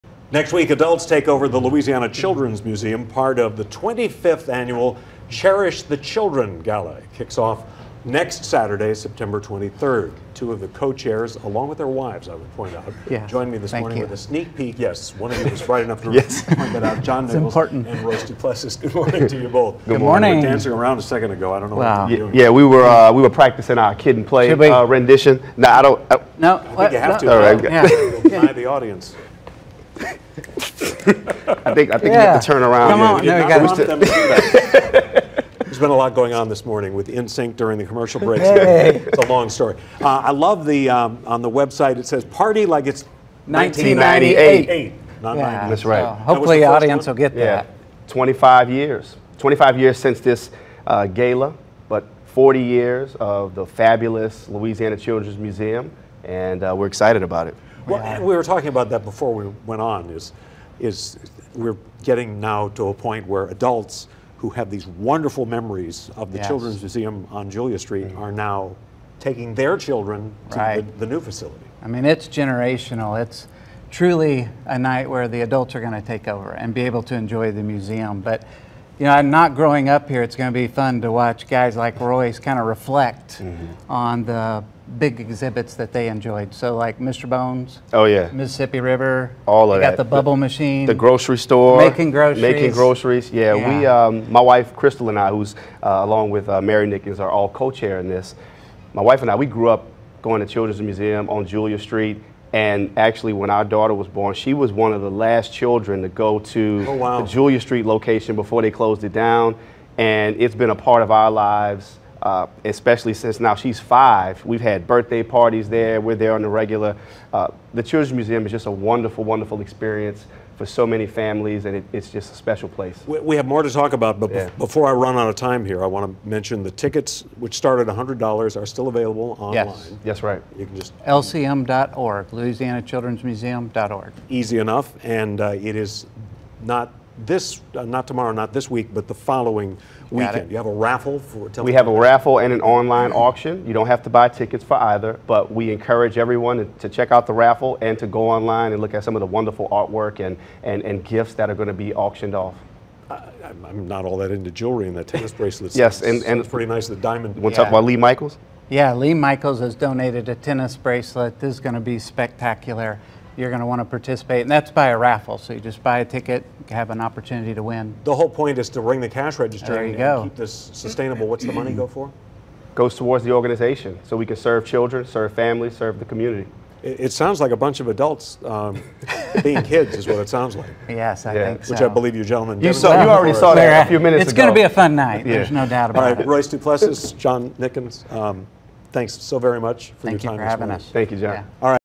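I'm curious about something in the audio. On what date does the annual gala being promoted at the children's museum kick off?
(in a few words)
September 23rd.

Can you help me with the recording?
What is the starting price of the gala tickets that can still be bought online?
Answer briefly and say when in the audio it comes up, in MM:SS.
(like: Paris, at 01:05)
$100, at 02:07.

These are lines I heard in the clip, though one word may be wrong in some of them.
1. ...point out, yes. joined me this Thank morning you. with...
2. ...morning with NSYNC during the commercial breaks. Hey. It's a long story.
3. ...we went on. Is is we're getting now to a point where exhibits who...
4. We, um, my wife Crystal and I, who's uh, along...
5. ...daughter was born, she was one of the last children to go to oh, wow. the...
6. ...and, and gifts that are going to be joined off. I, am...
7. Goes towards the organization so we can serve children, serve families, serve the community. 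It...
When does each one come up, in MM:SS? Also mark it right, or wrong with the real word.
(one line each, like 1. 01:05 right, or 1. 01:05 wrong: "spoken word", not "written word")
1. 00:12 right
2. 00:36 right
3. 00:59 wrong: "adults", not "exhibits"
4. 01:33 right
5. 01:43 right
6. 02:30 wrong: "auctioned", not "joined"
7. 02:52 right.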